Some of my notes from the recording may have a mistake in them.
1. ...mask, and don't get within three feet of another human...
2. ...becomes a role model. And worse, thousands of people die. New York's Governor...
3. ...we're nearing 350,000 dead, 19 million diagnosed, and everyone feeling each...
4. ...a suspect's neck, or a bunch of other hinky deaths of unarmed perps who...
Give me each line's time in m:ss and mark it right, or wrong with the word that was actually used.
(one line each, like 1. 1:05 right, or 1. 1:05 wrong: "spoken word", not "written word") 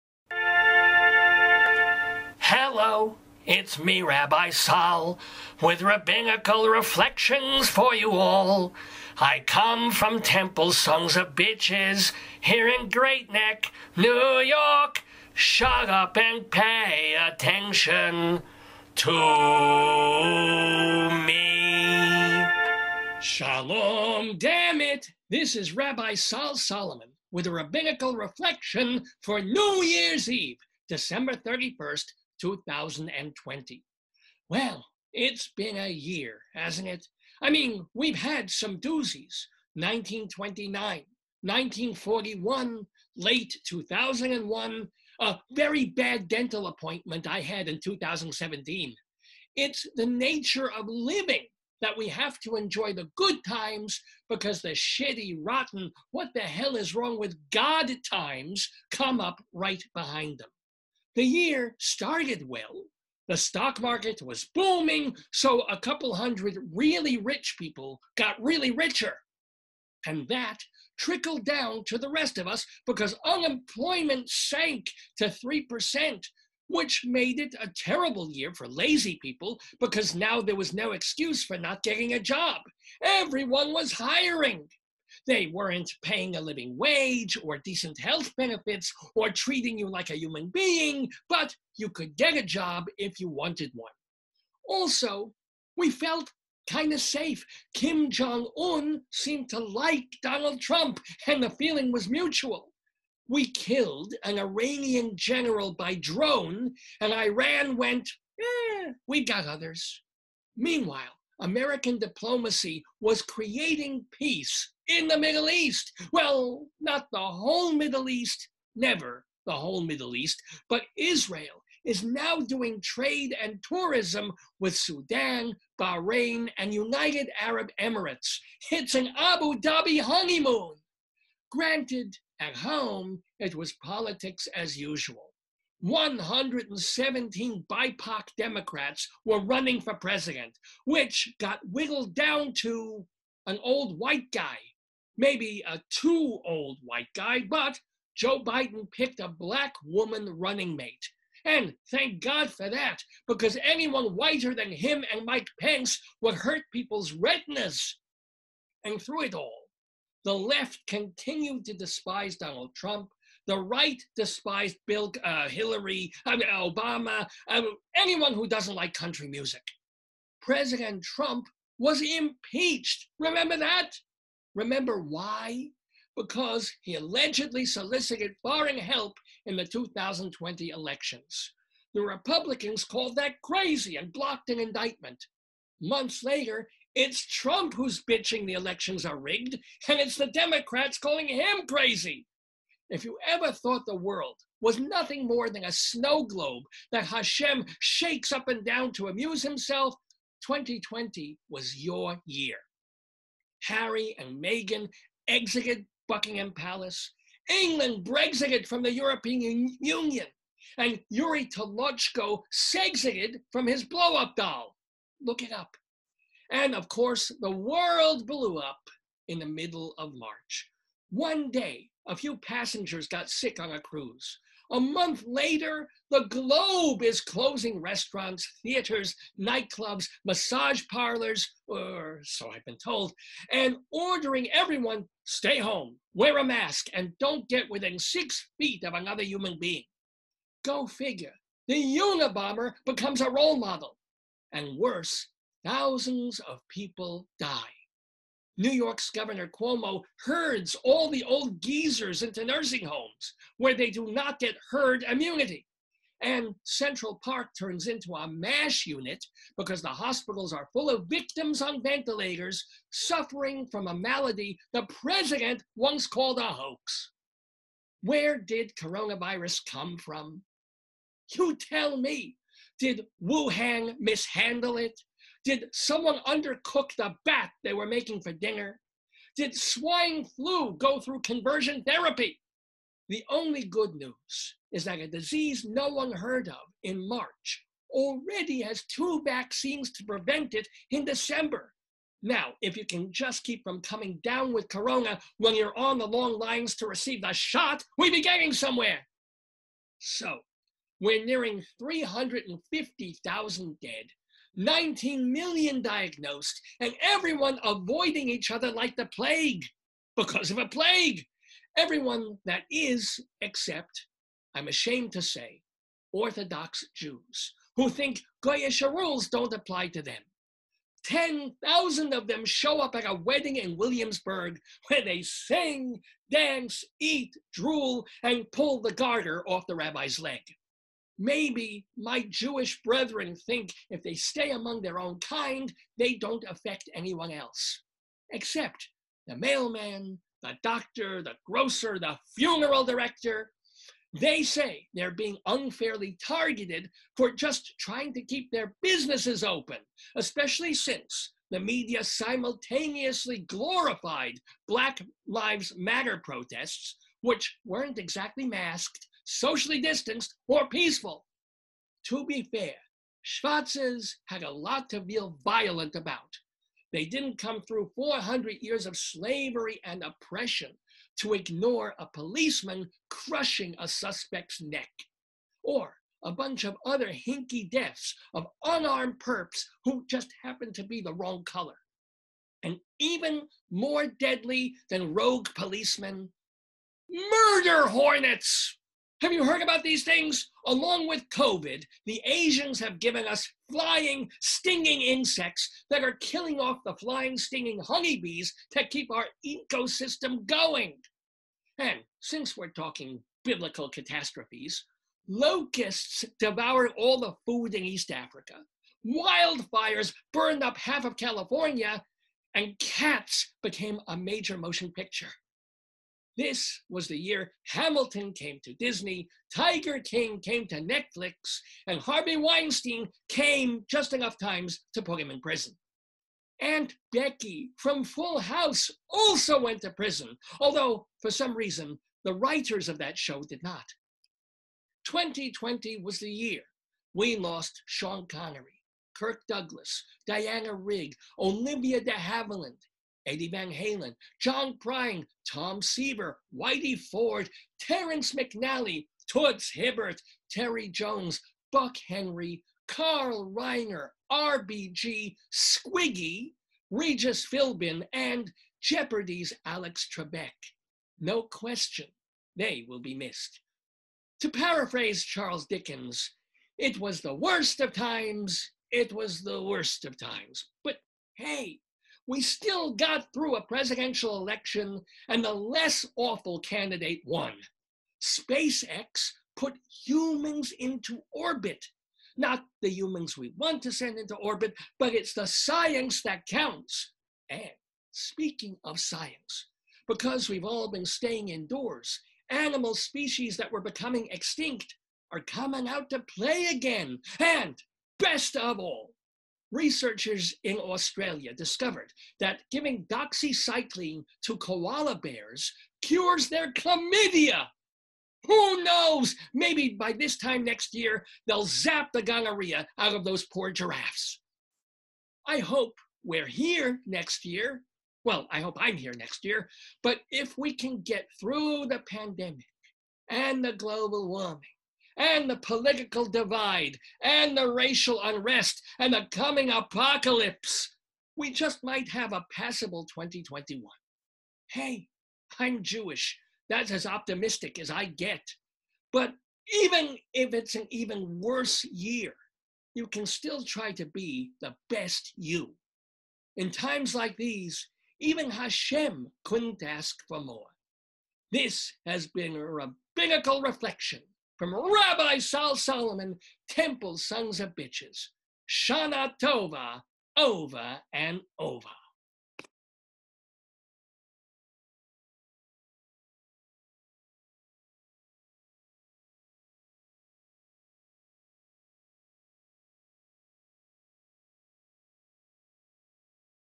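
1. 3:56 wrong: "six", not "three"
2. 4:02 right
3. 5:00 wrong: "avoiding", not "feeling"
4. 6:13 right.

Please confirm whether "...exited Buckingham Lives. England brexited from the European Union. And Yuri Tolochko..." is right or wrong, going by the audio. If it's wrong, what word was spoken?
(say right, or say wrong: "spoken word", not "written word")
wrong: "Palace", not "Lives".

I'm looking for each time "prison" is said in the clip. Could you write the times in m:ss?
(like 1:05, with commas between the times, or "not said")
7:05, 7:09.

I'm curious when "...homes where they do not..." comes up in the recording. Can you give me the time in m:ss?
4:12.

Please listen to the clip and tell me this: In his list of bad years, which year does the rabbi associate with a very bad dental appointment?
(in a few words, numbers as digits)
2017.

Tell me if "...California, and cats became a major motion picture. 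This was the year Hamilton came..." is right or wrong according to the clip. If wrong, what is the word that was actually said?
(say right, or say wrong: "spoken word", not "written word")
right.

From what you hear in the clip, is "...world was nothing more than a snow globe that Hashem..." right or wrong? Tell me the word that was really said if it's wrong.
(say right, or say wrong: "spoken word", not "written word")
right.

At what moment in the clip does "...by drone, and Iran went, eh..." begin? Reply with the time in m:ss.
1:45.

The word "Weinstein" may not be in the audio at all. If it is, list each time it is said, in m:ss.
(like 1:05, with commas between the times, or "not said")
7:02.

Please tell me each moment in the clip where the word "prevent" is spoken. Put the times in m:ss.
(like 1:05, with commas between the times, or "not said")
4:50.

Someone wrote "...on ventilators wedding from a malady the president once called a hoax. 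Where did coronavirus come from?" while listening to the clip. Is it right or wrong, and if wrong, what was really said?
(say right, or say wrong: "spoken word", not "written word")
wrong: "suffering", not "wedding".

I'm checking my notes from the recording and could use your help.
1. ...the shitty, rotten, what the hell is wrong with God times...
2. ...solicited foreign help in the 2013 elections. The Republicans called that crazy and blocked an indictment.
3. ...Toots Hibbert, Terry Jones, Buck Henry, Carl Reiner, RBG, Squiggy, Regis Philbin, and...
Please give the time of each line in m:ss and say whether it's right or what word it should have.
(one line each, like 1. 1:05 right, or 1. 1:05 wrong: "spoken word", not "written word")
1. 0:54 right
2. 2:57 wrong: "2020", not "2013"
3. 7:29 right.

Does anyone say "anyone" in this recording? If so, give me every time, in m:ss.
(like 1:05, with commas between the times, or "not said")
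2:33, 2:47, 5:36.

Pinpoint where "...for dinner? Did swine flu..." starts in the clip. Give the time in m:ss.
4:38.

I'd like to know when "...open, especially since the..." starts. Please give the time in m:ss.
5:49.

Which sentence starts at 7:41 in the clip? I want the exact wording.
No question, they will be missed.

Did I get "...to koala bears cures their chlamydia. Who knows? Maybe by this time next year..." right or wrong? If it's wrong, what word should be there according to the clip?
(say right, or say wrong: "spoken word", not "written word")
right.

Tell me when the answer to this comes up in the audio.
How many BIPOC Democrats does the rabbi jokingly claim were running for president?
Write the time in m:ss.
2:15.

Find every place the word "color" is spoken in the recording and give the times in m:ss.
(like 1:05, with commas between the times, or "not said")
6:21.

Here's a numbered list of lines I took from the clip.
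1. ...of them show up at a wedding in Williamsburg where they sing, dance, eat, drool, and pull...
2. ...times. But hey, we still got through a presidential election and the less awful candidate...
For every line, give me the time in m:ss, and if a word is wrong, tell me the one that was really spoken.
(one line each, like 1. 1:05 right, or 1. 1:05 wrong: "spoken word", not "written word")
1. 5:22 right
2. 7:50 right.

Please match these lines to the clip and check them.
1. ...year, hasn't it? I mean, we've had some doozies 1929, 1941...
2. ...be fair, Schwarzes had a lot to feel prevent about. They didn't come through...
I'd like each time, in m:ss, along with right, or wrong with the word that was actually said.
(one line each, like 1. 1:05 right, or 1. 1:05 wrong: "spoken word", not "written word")
1. 0:35 right
2. 6:02 wrong: "violent", not "prevent".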